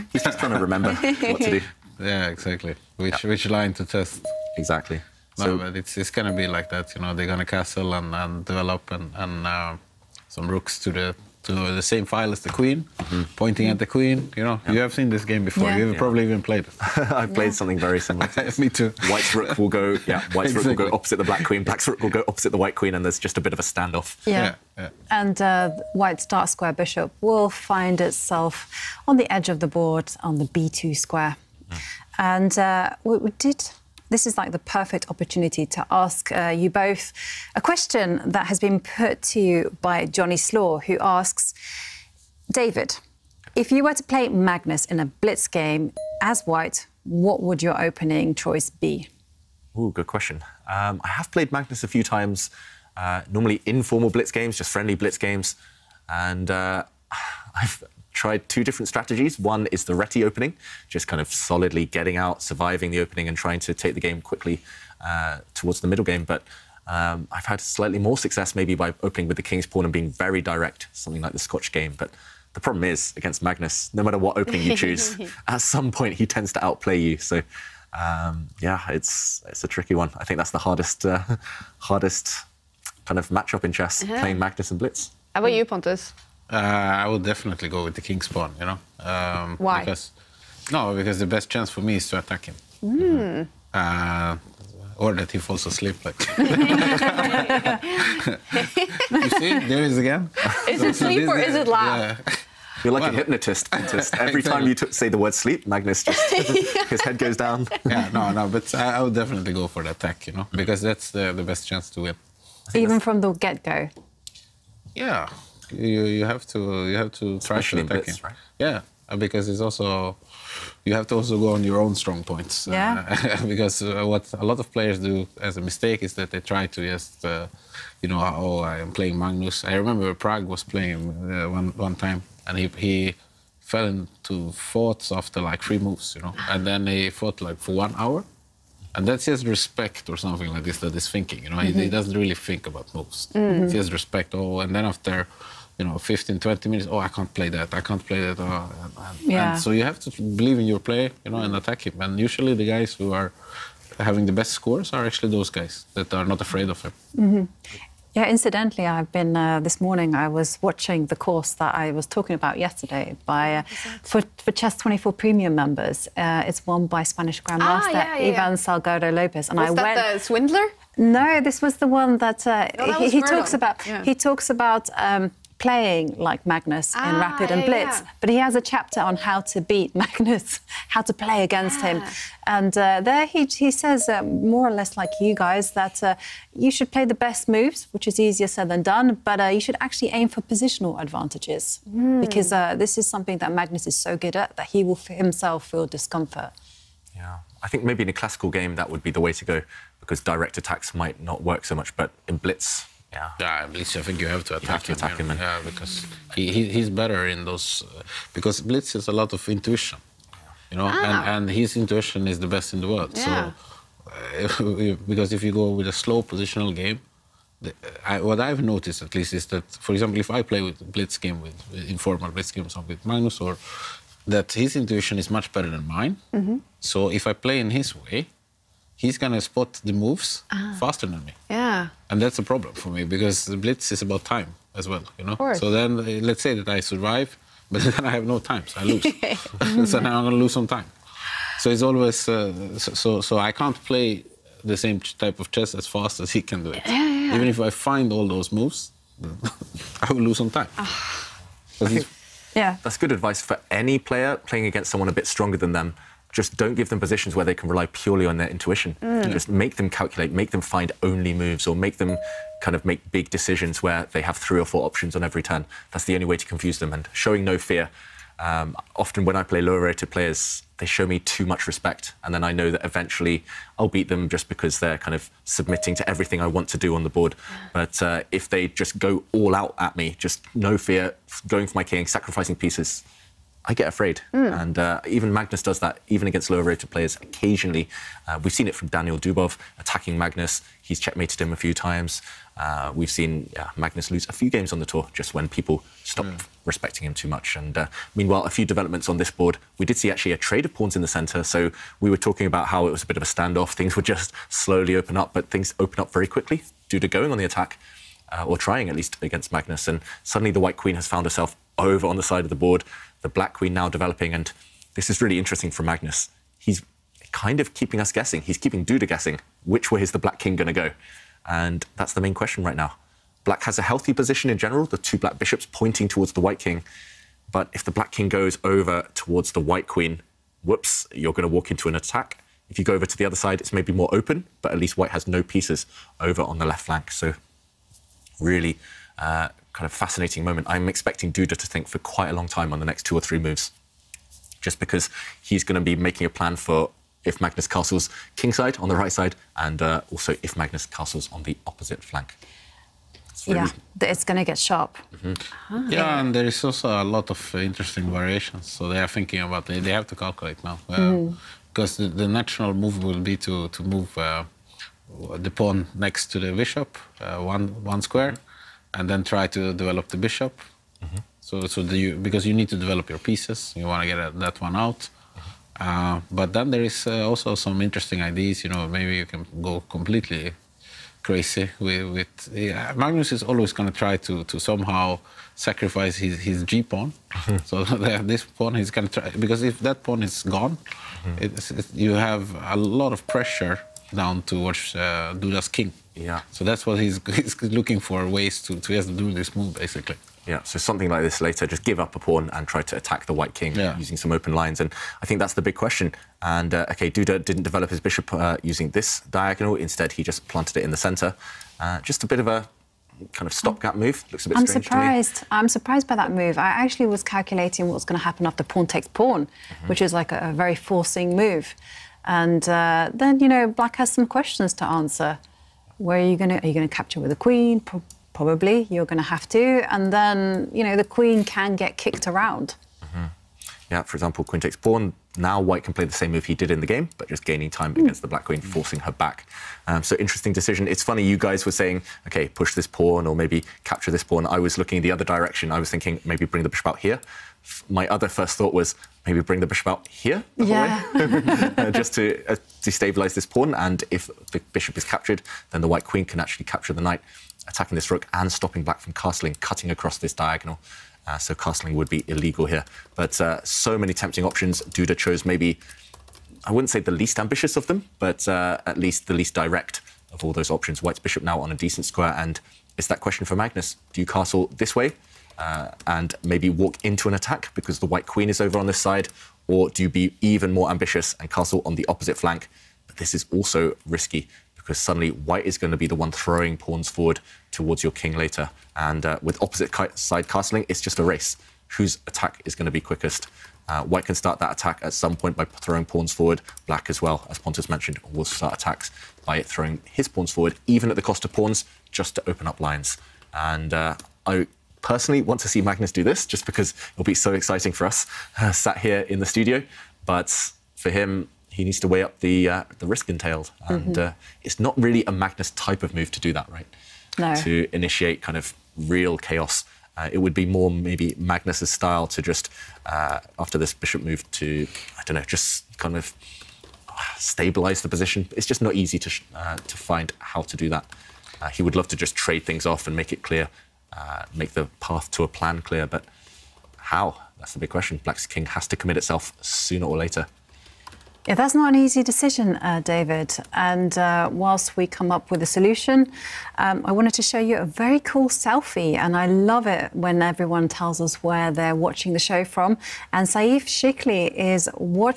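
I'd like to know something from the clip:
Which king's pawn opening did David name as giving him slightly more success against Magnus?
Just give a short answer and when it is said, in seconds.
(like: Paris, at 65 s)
Scotch game, at 71 s.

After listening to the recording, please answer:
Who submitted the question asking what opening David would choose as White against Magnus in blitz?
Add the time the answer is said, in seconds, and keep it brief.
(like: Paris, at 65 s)
Johnny Slaw, at 40 s.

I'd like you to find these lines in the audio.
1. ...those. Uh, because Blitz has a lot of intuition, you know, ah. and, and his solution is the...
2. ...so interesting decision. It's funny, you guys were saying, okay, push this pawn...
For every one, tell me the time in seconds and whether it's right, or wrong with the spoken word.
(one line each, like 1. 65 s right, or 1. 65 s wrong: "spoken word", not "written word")
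1. 207 s wrong: "intuition", not "solution"
2. 440 s right.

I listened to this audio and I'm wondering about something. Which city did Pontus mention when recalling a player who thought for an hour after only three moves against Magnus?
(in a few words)
Prague.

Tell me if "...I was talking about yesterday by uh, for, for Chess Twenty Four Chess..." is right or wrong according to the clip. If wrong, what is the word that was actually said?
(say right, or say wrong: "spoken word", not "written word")
wrong: "Premium", not "Chess".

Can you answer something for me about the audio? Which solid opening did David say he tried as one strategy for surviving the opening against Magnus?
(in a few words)
Reti.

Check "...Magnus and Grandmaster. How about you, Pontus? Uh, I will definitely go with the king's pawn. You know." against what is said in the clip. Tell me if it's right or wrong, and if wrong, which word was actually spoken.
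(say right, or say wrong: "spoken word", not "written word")
wrong: "Blitz", not "Grandmaster".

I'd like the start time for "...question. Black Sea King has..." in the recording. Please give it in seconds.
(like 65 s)
537 s.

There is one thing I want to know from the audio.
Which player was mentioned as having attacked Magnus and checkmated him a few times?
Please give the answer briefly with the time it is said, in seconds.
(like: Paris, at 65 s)
Daniel Dubov, at 288 s.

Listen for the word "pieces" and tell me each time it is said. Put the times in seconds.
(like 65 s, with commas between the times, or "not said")
282 s, 335 s, 373 s.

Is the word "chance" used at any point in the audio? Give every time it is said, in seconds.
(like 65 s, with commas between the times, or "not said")
91 s, 111 s.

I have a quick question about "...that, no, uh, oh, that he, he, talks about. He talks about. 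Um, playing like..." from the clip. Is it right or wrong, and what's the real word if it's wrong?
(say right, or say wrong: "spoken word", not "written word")
right.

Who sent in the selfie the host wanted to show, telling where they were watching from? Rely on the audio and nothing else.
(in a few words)
Saif Shikli.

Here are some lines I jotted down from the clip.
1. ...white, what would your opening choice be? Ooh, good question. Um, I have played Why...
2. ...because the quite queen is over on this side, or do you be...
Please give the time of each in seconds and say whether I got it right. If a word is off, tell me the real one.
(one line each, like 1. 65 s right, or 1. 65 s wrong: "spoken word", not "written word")
1. 46 s wrong: "Magnus", not "Why"
2. 477 s wrong: "white", not "quite".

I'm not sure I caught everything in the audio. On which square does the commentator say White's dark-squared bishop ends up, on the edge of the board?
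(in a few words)
b2.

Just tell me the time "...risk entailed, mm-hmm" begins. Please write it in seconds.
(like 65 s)
513 s.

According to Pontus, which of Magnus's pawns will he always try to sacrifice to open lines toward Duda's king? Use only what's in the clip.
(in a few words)
G pawn.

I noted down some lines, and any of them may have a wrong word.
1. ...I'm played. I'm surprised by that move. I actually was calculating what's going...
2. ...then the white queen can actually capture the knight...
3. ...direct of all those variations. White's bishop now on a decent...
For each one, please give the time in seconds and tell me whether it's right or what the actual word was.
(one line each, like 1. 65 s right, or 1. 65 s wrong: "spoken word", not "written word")
1. 414 s wrong: "surprised", not "played"
2. 455 s right
3. 469 s wrong: "options", not "variations".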